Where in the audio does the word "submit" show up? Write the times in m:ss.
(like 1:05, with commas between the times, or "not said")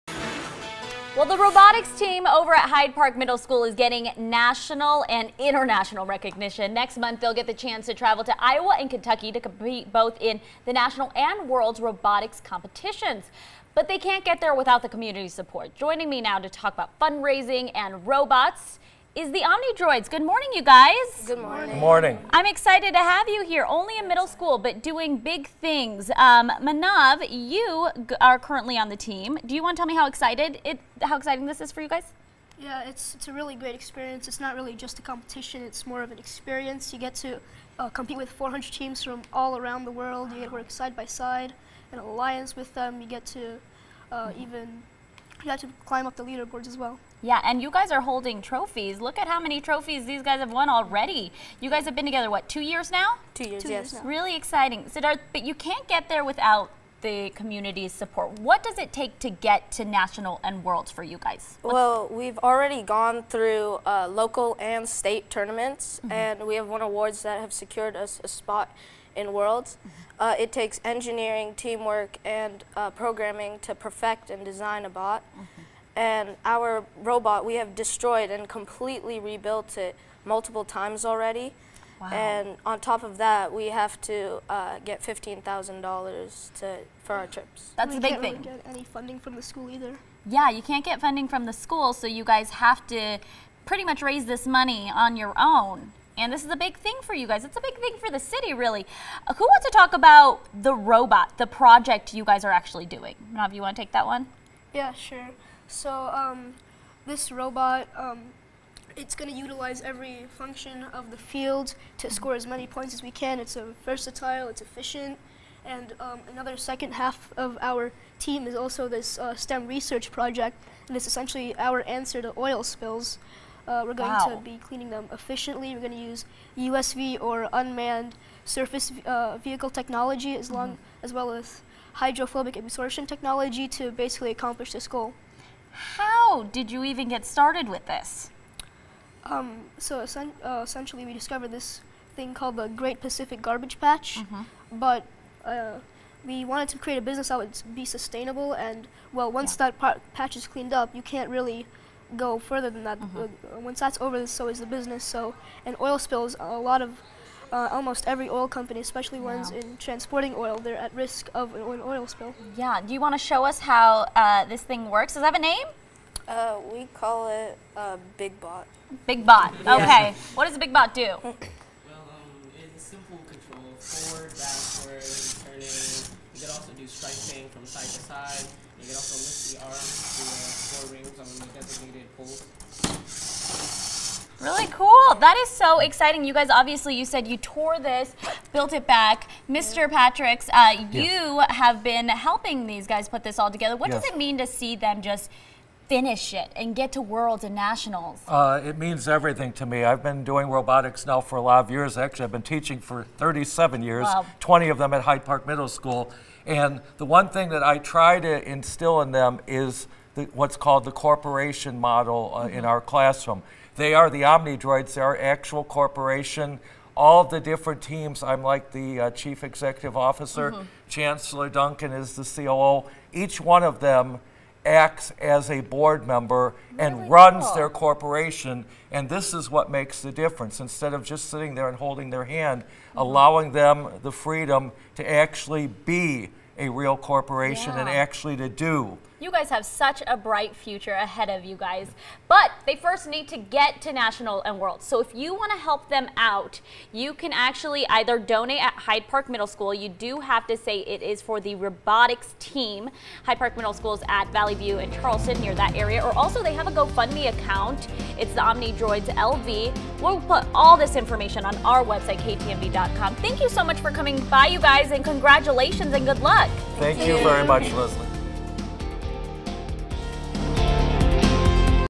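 not said.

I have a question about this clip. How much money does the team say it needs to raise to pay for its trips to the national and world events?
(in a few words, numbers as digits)
$15,000.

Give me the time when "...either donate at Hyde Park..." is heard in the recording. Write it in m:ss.
4:07.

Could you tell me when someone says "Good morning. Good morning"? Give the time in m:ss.
0:21.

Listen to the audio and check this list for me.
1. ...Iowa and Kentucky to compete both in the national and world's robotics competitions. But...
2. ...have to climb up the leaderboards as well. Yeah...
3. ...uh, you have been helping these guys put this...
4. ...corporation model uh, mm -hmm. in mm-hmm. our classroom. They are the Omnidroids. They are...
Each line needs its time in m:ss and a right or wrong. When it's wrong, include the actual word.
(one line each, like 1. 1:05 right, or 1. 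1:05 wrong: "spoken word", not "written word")
1. 0:08 right
2. 0:45 right
3. 3:10 right
4. 3:30 right.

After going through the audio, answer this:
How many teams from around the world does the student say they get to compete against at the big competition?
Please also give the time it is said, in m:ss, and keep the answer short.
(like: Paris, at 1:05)
400, at 0:38.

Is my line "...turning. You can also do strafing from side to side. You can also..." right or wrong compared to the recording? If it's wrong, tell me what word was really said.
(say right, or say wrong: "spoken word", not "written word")
right.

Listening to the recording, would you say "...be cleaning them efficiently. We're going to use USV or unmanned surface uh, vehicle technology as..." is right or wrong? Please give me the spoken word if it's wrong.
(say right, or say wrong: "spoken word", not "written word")
right.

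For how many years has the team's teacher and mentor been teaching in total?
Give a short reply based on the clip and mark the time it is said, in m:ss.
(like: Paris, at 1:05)
37, at 3:23.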